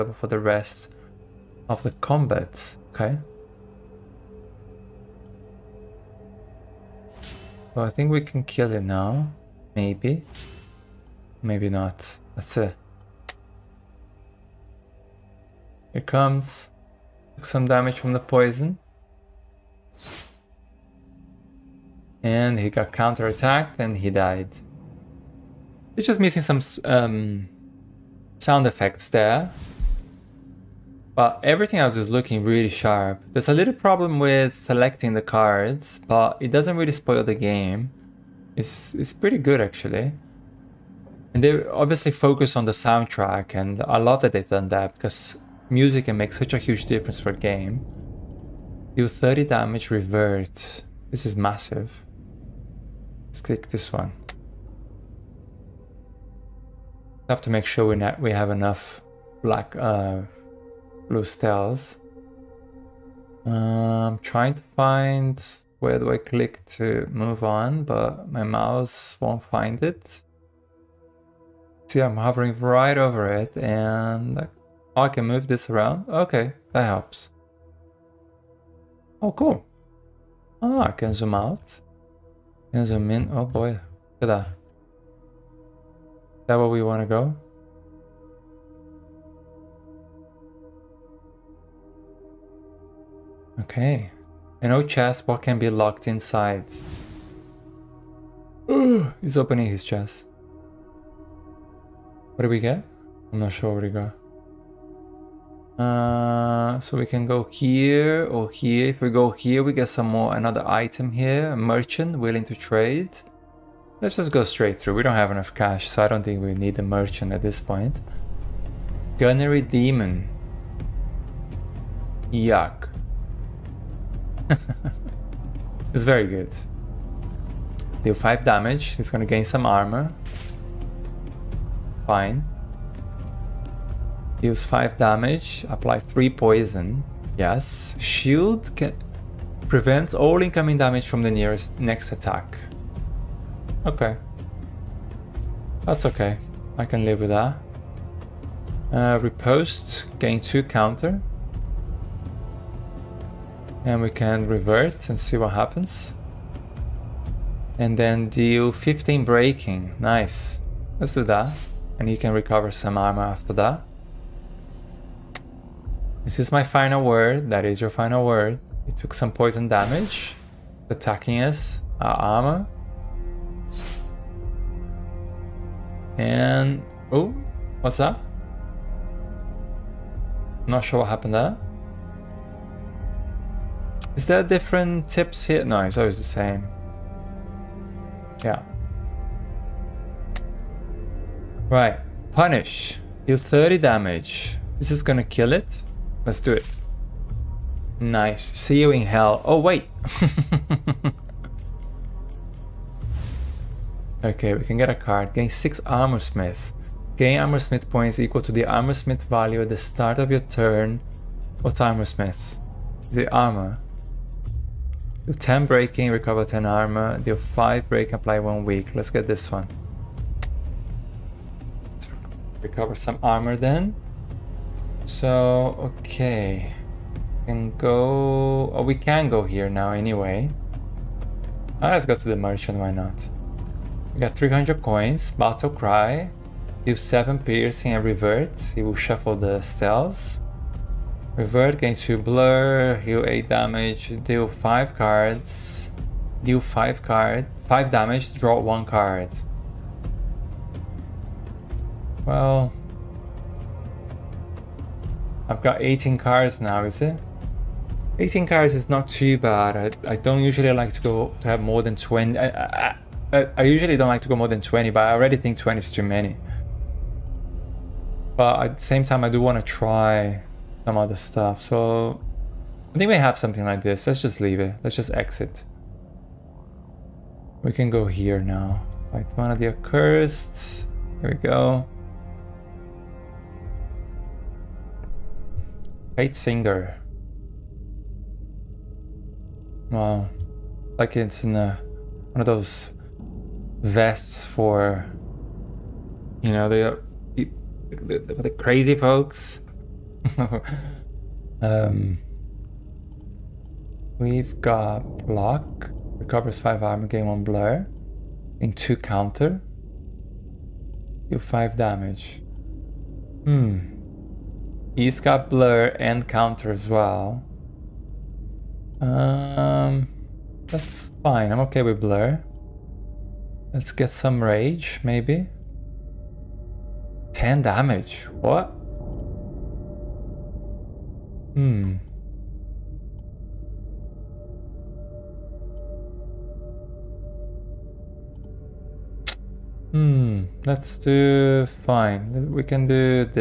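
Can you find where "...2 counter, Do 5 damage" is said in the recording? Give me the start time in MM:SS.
05:08.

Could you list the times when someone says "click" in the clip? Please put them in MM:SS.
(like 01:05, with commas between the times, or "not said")
00:53, 01:06.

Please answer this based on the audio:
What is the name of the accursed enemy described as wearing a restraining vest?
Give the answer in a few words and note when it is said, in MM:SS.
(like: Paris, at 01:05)
Kate Singer, at 04:46.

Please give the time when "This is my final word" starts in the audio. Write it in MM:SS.
02:46.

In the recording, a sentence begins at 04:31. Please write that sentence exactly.
So I think we have something like this.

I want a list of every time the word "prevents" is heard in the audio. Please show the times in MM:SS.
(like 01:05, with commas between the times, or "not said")
02:19.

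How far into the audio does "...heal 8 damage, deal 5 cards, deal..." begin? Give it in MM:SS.
04:03.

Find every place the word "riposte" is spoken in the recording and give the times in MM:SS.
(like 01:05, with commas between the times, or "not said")
02:29.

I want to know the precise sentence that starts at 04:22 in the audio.
I, I, I usually don't like to go more than 20, but I already think 20 is too many.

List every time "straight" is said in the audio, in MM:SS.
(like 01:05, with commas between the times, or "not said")
01:54.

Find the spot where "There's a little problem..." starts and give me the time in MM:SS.
00:33.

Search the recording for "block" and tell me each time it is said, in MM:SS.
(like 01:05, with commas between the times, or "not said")
05:05.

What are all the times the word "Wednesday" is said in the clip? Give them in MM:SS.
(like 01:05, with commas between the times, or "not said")
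not said.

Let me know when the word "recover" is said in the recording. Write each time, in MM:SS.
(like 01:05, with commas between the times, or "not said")
02:42, 03:36, 03:42, 05:06.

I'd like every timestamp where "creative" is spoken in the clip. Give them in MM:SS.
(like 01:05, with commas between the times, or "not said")
not said.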